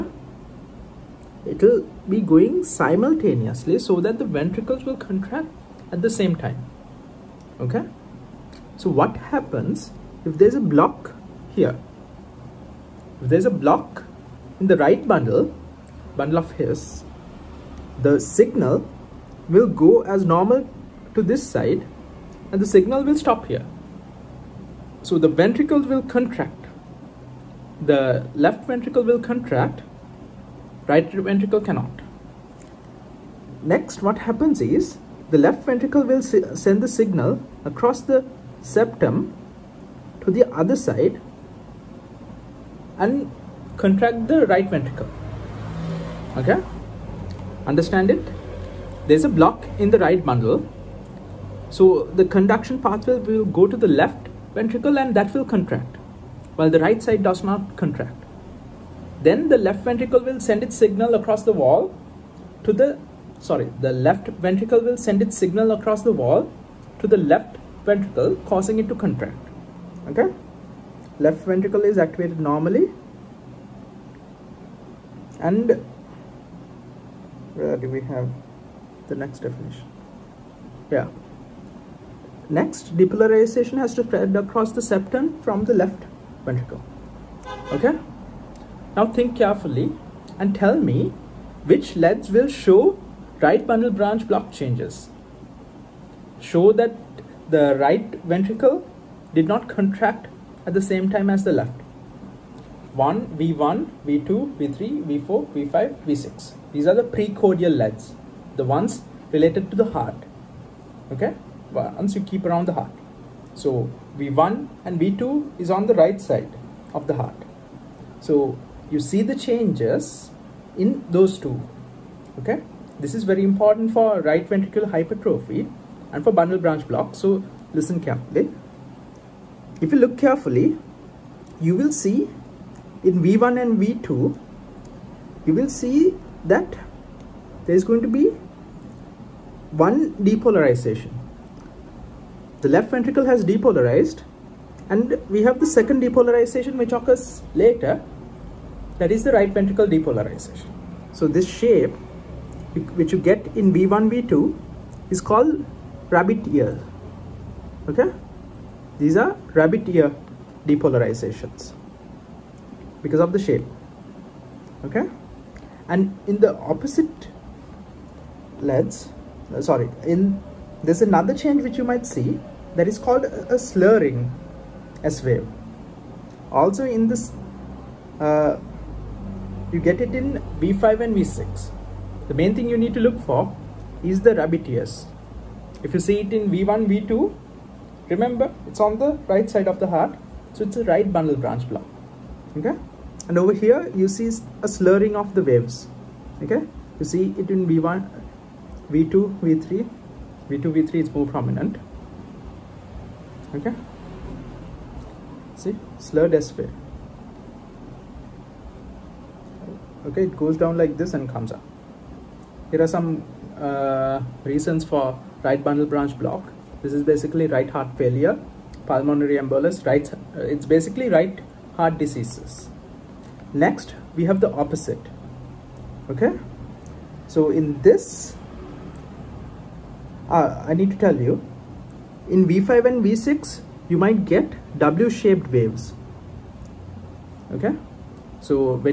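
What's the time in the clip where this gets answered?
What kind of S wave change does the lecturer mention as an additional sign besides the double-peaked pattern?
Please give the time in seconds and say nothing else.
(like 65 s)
173 s.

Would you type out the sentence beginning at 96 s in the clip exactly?
Show that the right ventricle did not contract at the same time as the left.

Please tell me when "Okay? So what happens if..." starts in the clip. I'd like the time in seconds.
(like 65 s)
7 s.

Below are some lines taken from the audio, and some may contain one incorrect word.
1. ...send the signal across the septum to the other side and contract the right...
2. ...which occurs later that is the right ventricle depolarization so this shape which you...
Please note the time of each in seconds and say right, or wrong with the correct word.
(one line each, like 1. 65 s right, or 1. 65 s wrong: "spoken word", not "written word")
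1. 36 s right
2. 146 s right.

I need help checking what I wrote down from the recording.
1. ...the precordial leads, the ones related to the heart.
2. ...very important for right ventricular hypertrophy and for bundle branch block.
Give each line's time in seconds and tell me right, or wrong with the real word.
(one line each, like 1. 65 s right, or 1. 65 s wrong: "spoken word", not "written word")
1. 106 s right
2. 123 s right.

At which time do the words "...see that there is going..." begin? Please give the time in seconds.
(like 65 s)
135 s.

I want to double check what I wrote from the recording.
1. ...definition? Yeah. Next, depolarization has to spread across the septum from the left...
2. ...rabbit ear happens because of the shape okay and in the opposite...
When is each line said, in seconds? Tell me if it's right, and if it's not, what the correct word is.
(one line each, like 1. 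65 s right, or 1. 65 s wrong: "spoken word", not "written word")
1. 79 s right
2. 159 s wrong: "depolarizations", not "happens".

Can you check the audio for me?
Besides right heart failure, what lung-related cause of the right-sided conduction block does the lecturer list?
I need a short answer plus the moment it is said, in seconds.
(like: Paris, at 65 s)
Pulmonary embolus, at 218 s.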